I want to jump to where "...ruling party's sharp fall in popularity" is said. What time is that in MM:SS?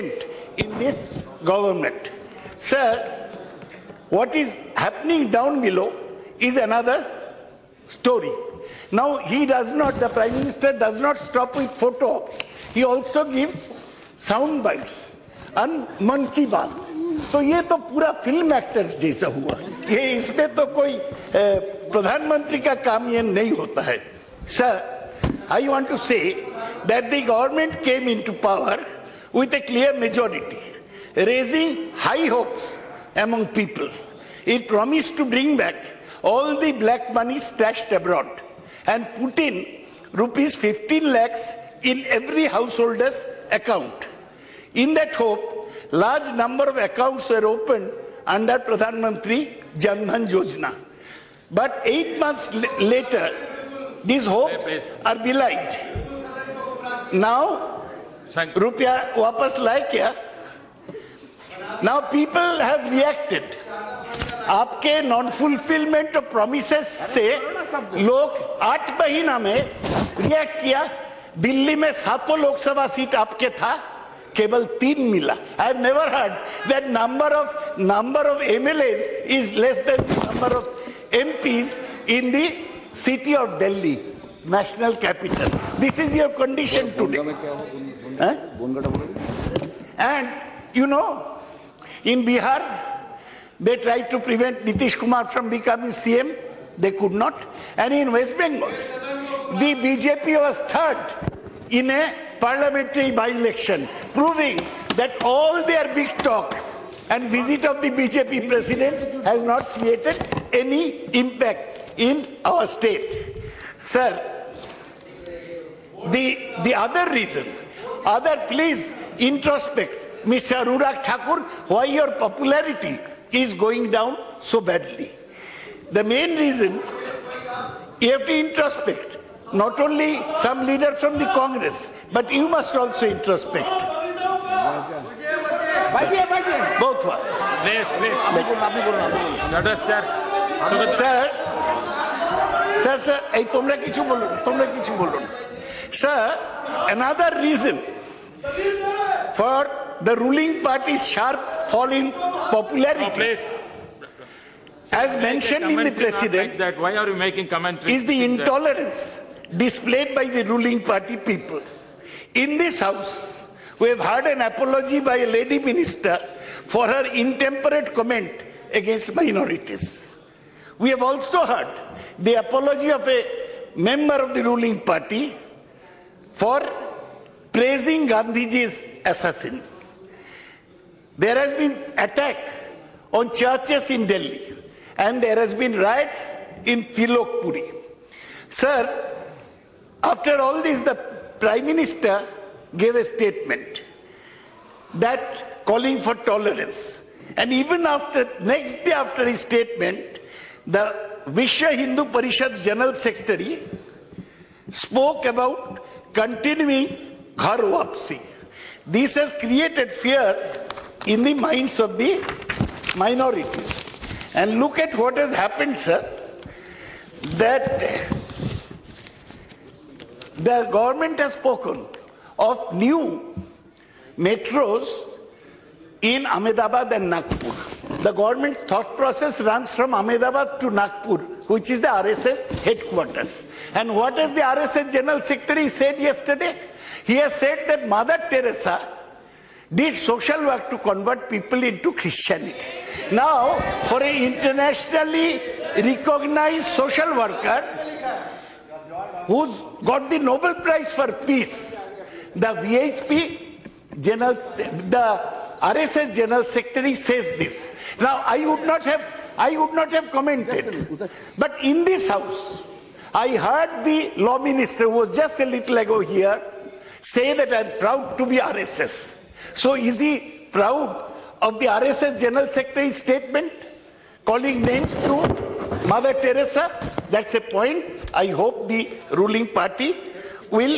02:30.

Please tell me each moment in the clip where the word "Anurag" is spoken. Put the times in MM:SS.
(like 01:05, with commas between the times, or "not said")
02:00.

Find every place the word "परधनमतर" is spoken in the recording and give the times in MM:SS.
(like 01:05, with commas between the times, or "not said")
00:21.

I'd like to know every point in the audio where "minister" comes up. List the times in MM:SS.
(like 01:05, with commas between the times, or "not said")
00:10, 02:45, 03:11, 04:24.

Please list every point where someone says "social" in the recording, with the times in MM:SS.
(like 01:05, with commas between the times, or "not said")
03:59, 04:06.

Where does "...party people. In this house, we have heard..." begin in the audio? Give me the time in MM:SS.
02:40.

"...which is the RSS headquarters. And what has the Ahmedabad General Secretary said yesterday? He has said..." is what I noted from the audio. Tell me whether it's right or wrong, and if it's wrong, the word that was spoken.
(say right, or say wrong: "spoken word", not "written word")
wrong: "RSS", not "Ahmedabad".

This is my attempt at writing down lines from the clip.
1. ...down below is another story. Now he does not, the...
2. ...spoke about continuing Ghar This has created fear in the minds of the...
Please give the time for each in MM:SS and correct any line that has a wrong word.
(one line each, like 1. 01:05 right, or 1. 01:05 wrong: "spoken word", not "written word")
1. 00:05 right
2. 03:24 right.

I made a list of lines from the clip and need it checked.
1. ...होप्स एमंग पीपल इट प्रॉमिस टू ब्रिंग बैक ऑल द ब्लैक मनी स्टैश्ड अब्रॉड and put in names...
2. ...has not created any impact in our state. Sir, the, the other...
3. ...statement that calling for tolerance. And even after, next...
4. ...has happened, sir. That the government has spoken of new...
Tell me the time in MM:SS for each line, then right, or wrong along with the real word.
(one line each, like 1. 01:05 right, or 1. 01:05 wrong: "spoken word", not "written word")
1. 00:32 wrong: "rupees", not "names"
2. 01:49 right
3. 03:13 right
4. 03:35 right.